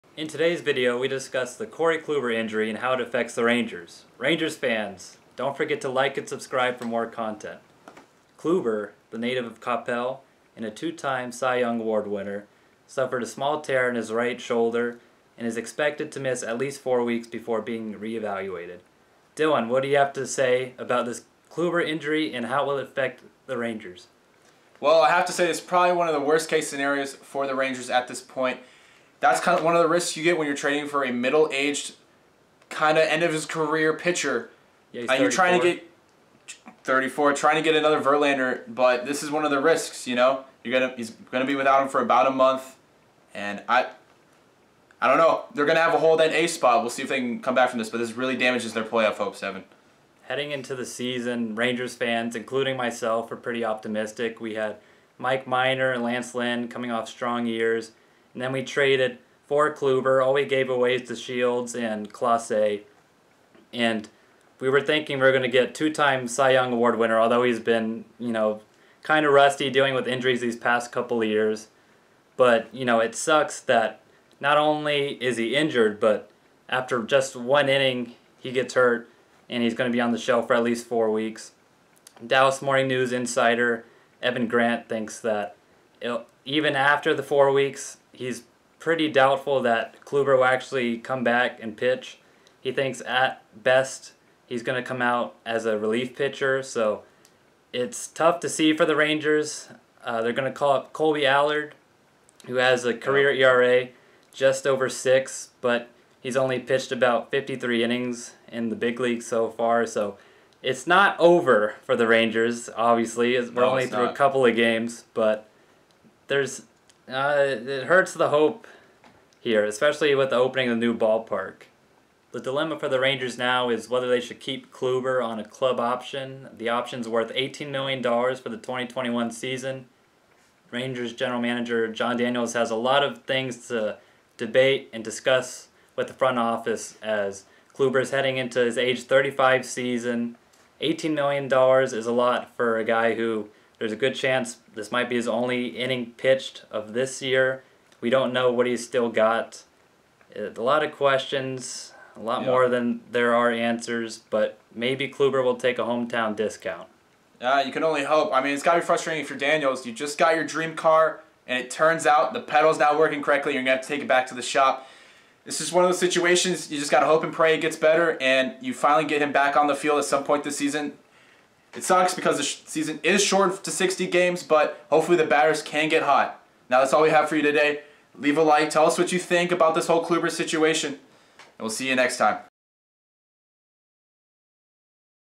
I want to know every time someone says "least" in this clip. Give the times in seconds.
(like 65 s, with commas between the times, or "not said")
16 s, 80 s.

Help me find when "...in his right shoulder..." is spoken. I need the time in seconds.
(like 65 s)
13 s.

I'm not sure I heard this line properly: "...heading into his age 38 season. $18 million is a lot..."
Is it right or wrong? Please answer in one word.
wrong.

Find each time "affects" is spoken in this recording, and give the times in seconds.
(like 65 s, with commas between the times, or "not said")
2 s, 22 s.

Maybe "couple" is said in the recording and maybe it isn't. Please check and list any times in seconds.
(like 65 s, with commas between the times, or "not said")
70 s, 114 s.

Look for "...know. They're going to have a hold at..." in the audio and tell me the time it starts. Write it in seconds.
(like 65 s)
45 s.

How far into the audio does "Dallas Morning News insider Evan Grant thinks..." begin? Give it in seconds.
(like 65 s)
82 s.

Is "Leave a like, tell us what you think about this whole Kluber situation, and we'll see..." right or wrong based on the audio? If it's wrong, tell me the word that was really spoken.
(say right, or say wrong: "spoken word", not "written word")
right.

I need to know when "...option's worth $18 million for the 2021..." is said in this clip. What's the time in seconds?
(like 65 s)
126 s.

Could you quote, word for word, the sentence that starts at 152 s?
more than there are answers, but maybe Kluber will take a hometown discount.